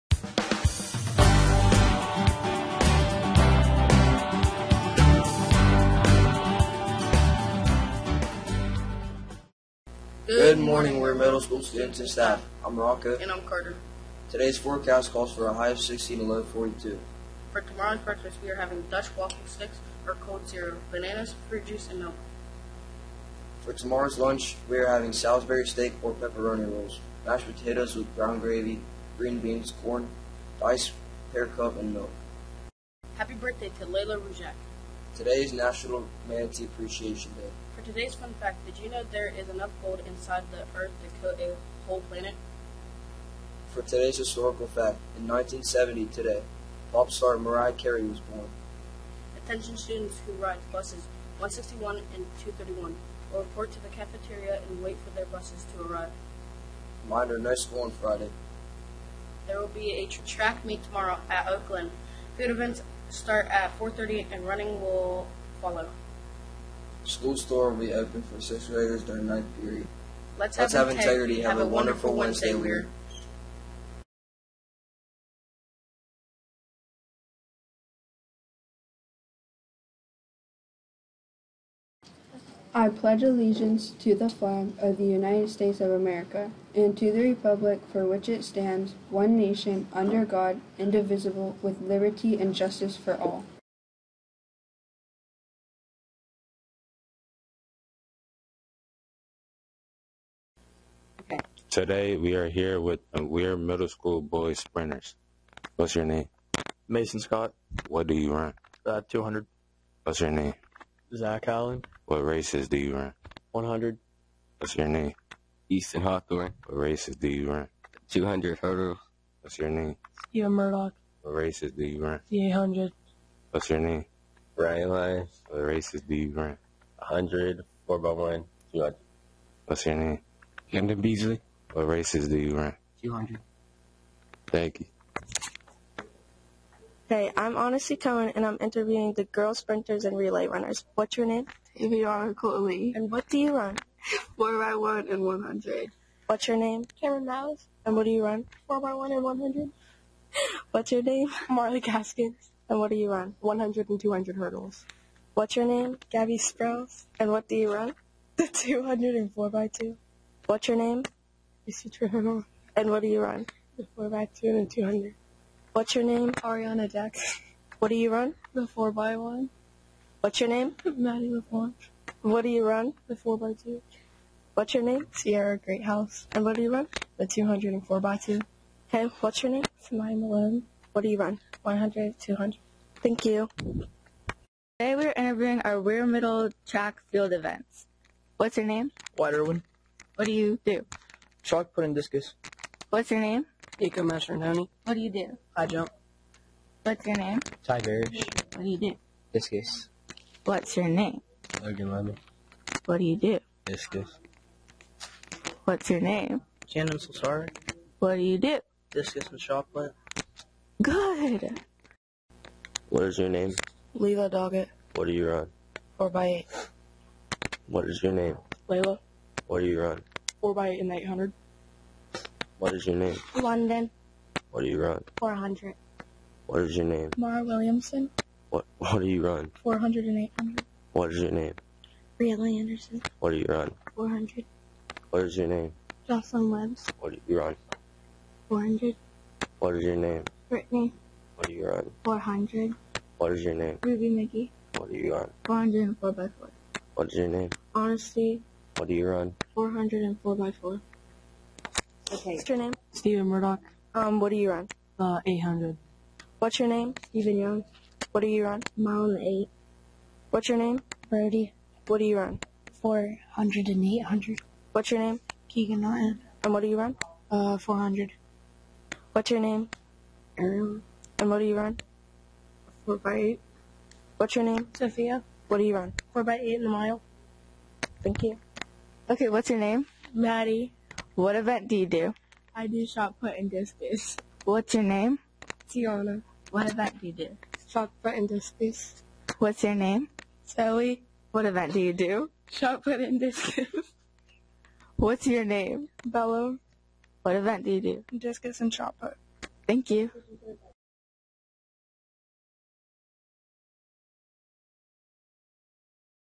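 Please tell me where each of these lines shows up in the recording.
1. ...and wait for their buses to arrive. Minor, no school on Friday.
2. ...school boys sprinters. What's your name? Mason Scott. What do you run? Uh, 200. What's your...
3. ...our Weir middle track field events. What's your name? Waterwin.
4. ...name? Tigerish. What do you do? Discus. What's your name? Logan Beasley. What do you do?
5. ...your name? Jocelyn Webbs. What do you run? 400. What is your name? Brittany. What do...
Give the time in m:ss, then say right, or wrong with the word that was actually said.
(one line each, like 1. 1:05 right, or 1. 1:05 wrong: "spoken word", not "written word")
1. 0:54 right
2. 1:43 right
3. 3:05 right
4. 3:17 wrong: "Lemon", not "Beasley"
5. 3:55 right.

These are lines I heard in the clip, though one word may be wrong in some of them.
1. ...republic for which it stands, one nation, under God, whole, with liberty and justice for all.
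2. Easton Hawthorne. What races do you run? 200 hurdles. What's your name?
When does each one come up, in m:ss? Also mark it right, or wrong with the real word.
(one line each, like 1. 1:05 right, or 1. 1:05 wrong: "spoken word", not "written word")
1. 1:27 wrong: "indivisible", not "whole"
2. 1:55 right.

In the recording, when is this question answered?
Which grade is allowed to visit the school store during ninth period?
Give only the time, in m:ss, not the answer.
1:08.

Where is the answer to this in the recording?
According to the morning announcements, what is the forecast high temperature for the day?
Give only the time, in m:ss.
0:15.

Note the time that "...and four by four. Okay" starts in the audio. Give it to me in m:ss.
4:10.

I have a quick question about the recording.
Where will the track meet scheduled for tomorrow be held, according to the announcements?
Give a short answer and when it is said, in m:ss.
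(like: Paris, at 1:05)
Oakland, at 1:01.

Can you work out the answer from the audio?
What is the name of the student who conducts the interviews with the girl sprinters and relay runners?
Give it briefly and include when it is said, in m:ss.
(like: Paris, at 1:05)
Honesty Cohen, at 2:17.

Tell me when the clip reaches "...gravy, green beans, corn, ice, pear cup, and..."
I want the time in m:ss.
0:28.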